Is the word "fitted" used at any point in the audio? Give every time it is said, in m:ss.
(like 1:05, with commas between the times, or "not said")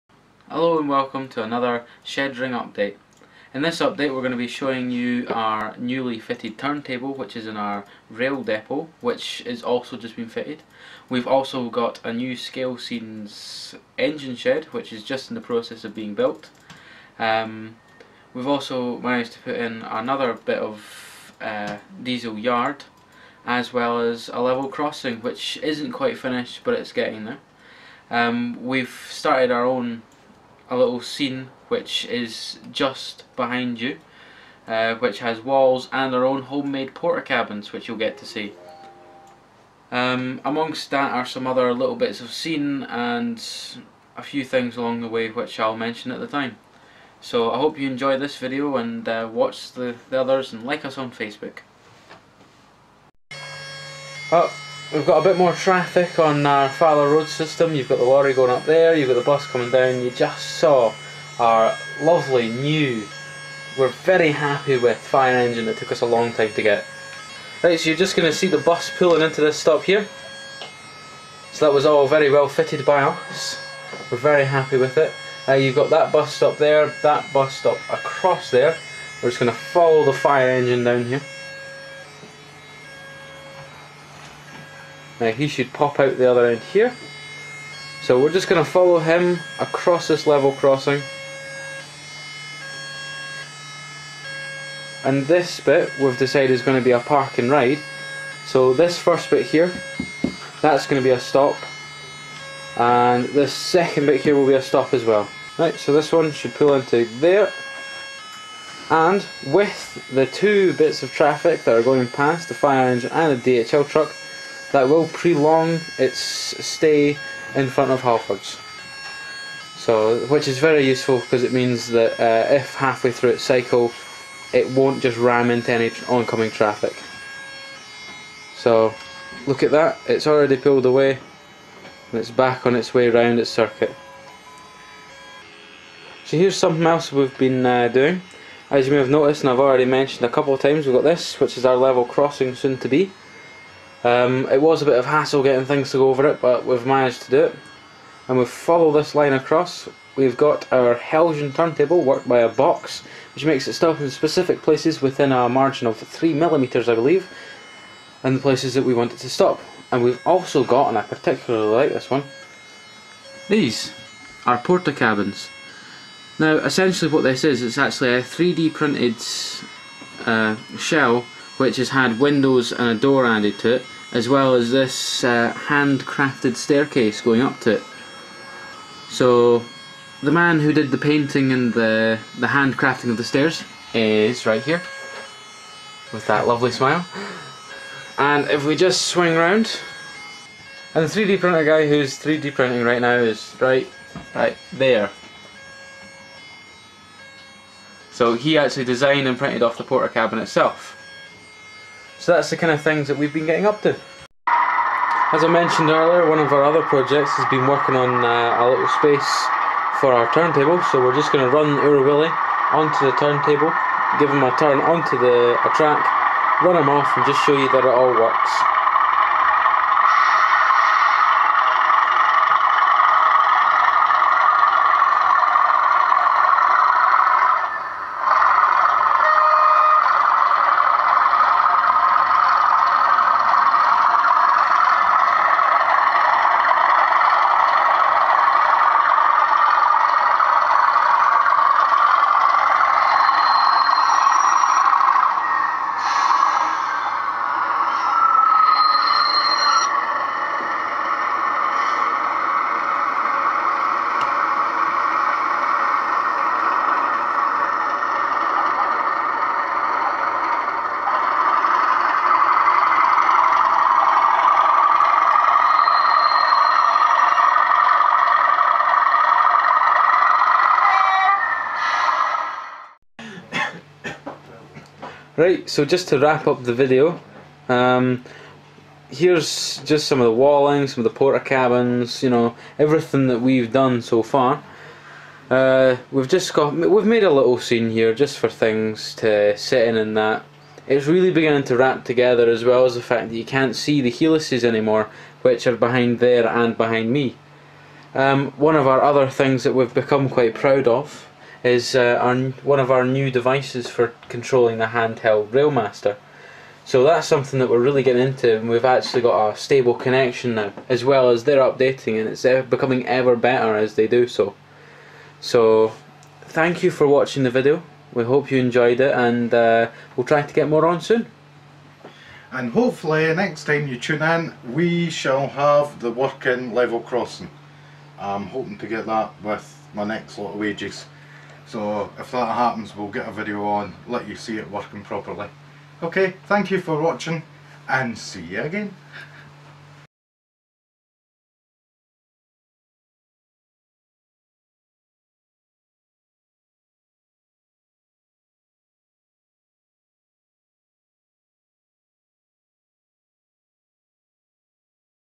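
0:06, 0:10, 1:12.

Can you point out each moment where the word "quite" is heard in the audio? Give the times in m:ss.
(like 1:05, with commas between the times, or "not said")
0:25, 5:00.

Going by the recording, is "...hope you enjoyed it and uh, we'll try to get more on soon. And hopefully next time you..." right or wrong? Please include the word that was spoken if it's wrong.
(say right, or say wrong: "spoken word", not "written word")
right.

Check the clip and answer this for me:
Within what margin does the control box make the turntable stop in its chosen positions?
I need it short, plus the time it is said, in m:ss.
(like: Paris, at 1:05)
3mm, at 2:35.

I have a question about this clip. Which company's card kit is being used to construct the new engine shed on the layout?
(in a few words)
Scalescenes.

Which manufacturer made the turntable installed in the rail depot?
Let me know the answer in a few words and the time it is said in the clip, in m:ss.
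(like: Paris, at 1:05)
Heljan, at 2:30.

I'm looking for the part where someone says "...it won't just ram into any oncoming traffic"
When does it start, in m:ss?
2:04.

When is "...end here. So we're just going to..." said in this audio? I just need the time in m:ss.
1:26.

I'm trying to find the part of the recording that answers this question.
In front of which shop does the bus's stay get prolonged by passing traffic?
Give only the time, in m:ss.
1:58.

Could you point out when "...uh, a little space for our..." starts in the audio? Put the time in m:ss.
3:28.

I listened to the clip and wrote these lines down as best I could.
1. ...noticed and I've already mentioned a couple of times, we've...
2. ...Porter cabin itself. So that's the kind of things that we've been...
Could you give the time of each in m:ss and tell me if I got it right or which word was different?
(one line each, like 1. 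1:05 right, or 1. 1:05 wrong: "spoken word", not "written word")
1. 2:19 right
2. 3:19 right.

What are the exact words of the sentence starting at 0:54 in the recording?
Oh we've got a bit more traffic on our uh, Faller Road system.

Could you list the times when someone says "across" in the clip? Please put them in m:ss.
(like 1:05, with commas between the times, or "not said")
1:17, 1:29, 2:29.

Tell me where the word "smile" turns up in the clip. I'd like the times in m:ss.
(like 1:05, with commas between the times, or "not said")
3:06.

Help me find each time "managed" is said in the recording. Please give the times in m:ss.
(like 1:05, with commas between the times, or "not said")
0:18, 2:26.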